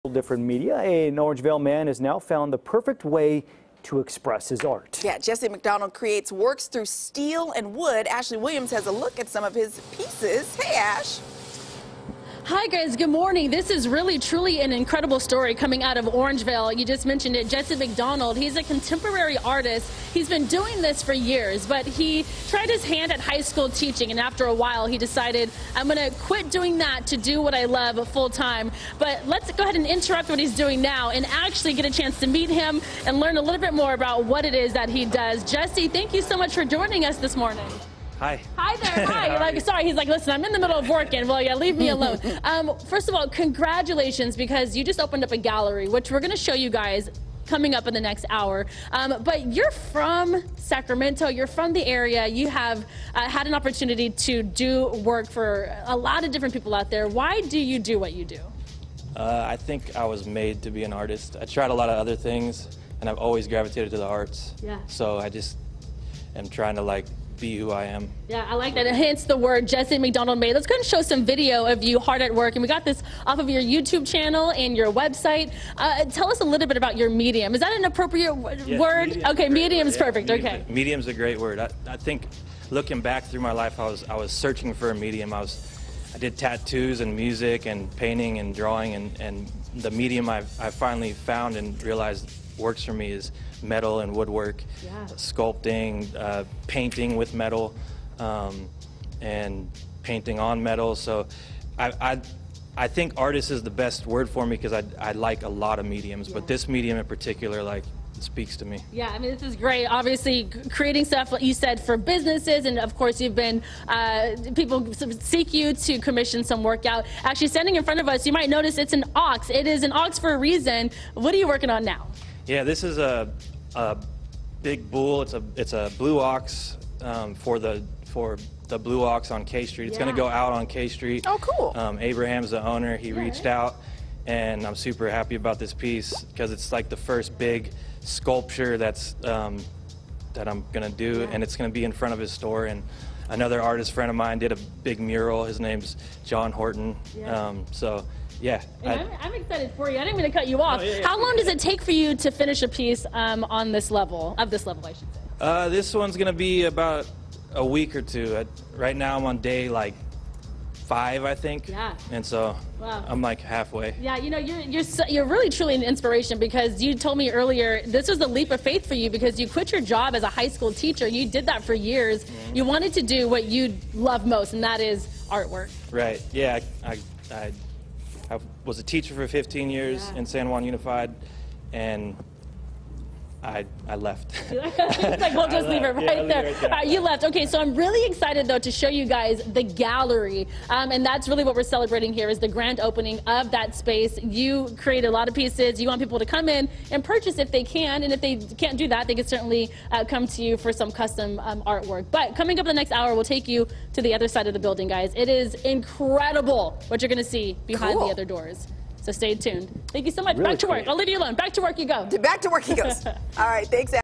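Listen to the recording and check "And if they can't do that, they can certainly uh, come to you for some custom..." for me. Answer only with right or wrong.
right.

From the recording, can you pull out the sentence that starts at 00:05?
Yeah, Jesse MacDonald creates works through steel and wood.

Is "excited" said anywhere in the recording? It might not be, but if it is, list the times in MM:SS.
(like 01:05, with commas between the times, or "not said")
02:29, 03:08.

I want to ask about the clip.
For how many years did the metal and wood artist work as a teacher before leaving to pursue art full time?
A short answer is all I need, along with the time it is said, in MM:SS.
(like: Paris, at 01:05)
15, at 02:59.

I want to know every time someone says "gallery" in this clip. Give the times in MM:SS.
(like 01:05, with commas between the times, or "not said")
00:45, 03:09.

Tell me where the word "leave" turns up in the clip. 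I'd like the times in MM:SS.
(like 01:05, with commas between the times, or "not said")
00:41, 03:05, 03:30.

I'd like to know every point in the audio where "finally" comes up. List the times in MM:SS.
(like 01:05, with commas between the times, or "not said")
01:30.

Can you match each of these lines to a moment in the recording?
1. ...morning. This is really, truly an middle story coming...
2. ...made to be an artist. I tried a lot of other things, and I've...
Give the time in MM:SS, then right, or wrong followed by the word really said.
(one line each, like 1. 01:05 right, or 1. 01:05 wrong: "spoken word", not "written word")
1. 00:13 wrong: "incredible", not "middle"
2. 01:00 right.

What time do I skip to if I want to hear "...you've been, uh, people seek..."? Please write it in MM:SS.
01:53.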